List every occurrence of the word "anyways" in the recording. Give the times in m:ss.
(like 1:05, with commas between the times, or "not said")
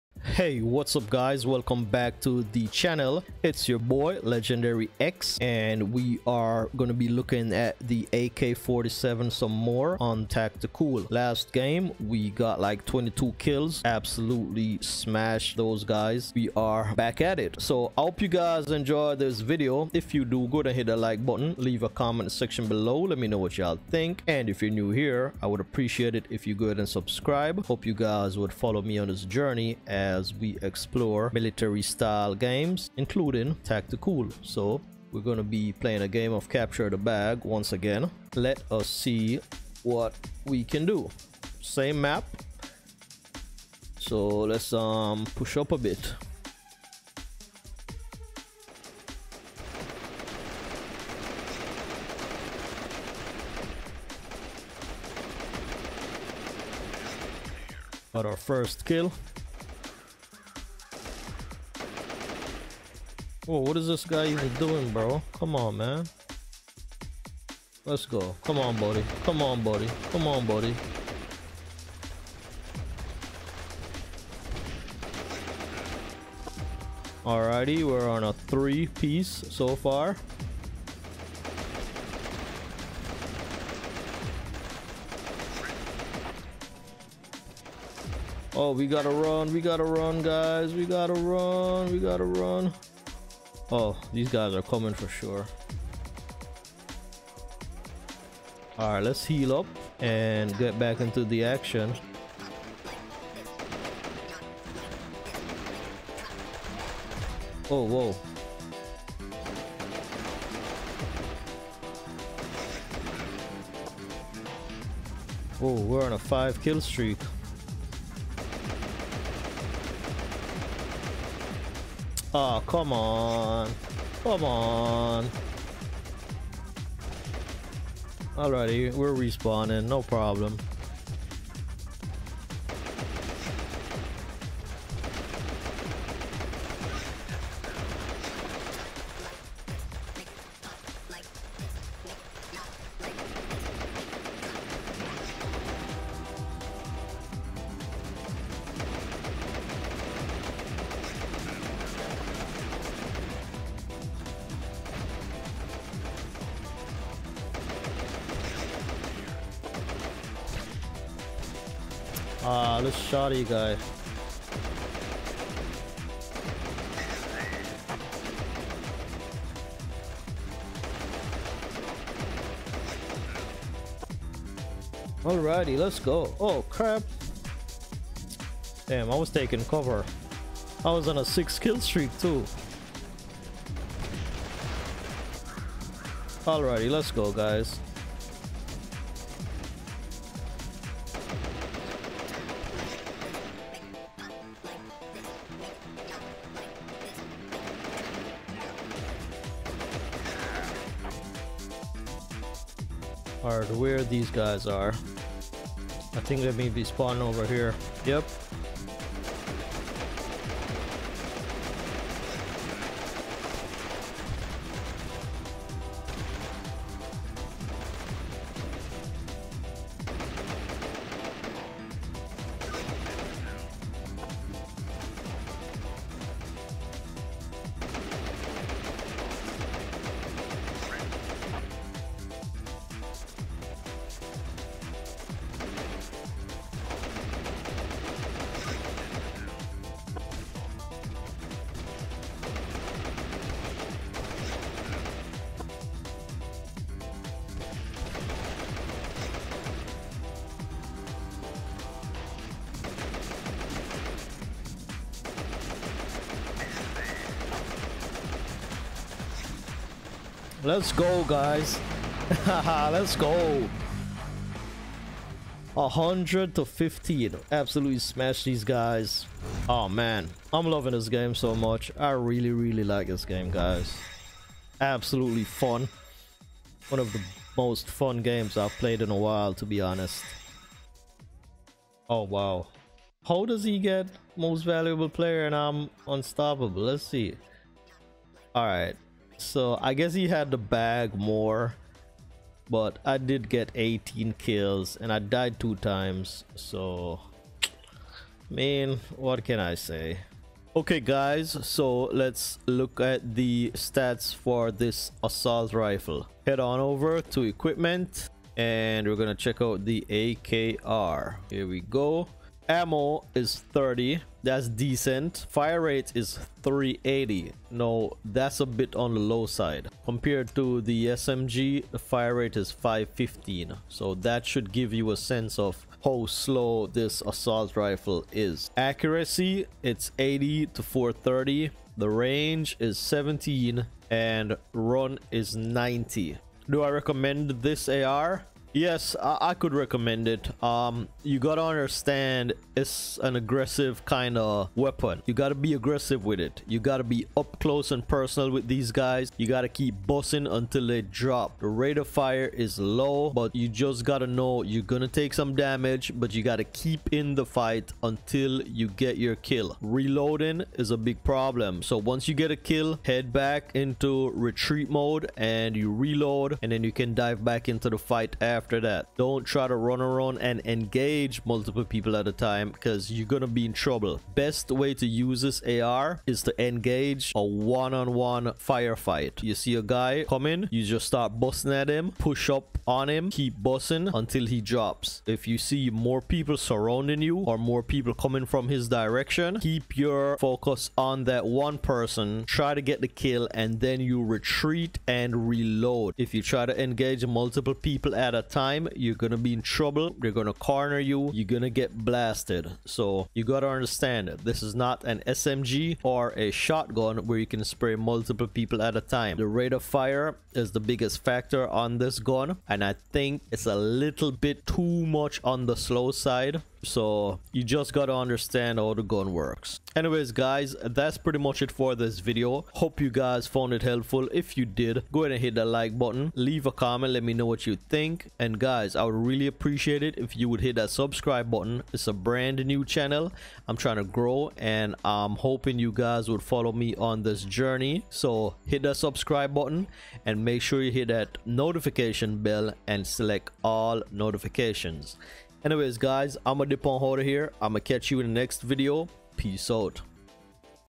6:59, 7:25.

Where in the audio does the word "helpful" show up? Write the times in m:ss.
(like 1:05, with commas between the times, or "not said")
7:03.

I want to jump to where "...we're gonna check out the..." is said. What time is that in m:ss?
5:09.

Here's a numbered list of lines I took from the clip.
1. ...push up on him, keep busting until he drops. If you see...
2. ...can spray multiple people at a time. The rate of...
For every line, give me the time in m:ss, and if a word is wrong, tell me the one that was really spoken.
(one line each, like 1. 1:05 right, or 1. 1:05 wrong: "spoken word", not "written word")
1. 6:22 right
2. 6:47 right.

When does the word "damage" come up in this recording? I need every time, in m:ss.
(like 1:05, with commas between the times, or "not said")
5:55.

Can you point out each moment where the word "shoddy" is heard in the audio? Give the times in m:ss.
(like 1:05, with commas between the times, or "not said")
2:42.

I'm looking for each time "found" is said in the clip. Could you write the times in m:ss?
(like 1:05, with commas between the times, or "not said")
7:03.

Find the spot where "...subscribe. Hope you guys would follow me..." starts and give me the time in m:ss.
0:26.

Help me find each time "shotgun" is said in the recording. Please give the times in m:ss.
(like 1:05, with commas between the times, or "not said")
6:46.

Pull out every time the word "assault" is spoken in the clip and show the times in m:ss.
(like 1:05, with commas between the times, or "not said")
5:05, 5:27.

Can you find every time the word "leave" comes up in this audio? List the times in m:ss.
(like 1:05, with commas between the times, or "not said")
0:21, 7:06.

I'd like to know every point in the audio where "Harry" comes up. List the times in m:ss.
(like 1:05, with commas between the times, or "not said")
not said.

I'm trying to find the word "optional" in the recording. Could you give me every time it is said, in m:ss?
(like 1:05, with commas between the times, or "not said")
not said.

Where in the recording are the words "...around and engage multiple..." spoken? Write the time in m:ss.
6:10.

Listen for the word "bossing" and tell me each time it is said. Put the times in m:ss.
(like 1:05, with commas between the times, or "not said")
5:50.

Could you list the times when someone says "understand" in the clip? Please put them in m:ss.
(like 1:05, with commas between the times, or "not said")
5:41, 6:43, 6:58.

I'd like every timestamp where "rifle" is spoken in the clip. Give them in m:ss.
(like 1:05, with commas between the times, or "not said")
5:05, 5:27.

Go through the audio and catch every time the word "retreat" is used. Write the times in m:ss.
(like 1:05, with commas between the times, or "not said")
6:04, 6:34.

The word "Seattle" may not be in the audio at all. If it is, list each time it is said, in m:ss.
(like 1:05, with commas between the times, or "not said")
not said.